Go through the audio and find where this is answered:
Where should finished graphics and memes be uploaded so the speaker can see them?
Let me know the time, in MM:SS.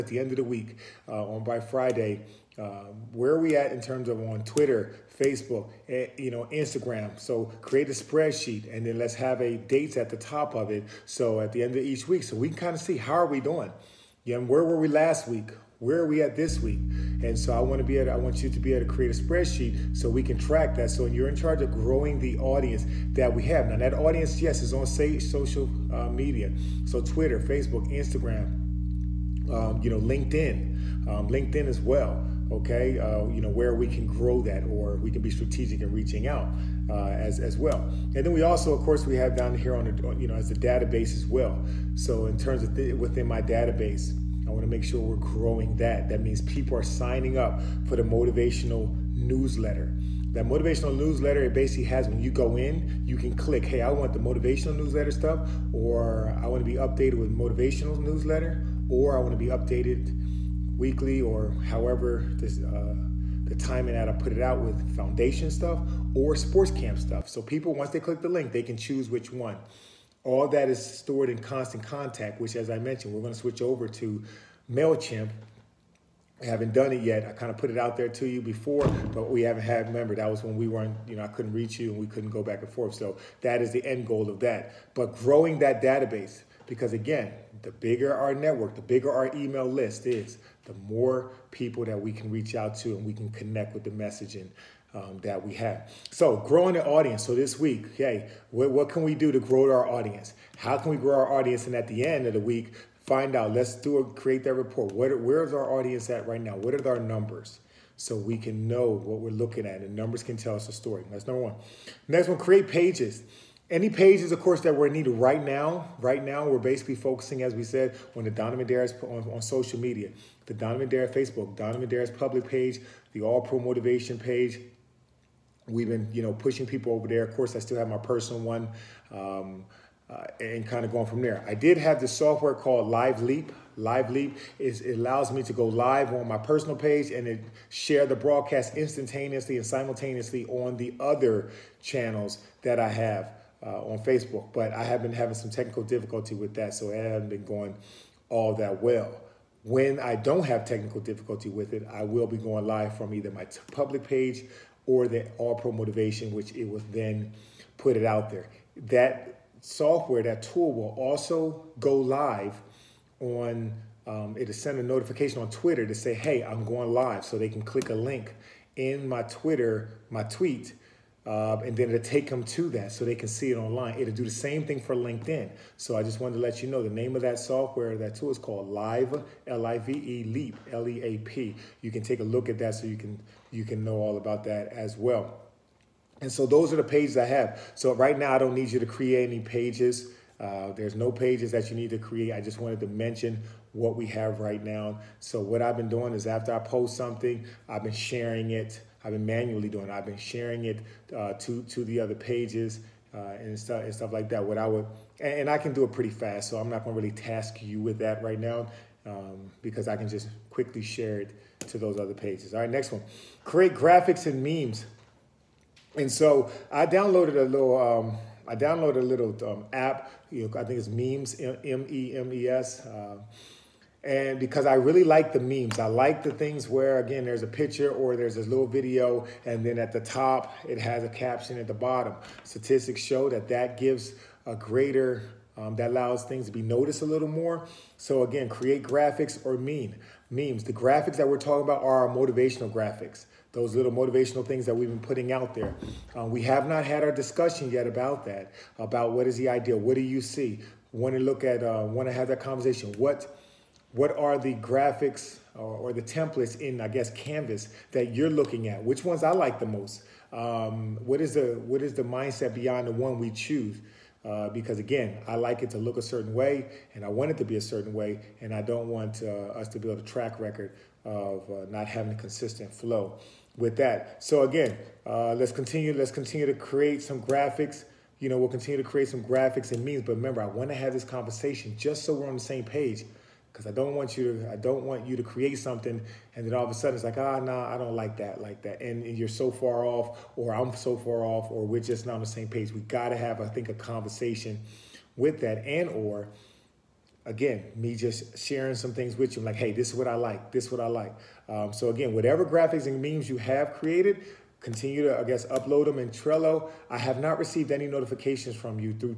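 05:06.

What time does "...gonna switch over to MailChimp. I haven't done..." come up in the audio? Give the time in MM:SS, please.
01:13.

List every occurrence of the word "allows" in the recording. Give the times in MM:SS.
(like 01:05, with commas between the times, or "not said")
02:14, 03:55.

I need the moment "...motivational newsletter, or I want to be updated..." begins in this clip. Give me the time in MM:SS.
00:57.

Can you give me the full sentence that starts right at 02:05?
We've been, you know, pushing people over there.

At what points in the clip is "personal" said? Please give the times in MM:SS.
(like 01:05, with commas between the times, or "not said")
02:07, 02:16.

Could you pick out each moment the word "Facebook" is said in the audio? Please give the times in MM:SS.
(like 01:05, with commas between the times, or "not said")
00:05, 00:27, 02:01, 02:23.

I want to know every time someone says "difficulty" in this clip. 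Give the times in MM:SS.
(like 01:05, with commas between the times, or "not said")
02:25, 02:30.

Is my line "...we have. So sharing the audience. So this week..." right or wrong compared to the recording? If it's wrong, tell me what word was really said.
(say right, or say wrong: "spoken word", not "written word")
wrong: "growing", not "sharing".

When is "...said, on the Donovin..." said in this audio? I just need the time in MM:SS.
01:57.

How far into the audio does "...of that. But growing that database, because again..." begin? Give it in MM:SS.
01:24.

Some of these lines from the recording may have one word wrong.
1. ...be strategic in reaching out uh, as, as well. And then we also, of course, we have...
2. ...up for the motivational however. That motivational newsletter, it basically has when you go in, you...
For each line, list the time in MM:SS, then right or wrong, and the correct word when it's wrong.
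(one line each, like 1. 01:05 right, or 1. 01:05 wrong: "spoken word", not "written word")
1. 00:35 right
2. 00:47 wrong: "newsletter", not "however".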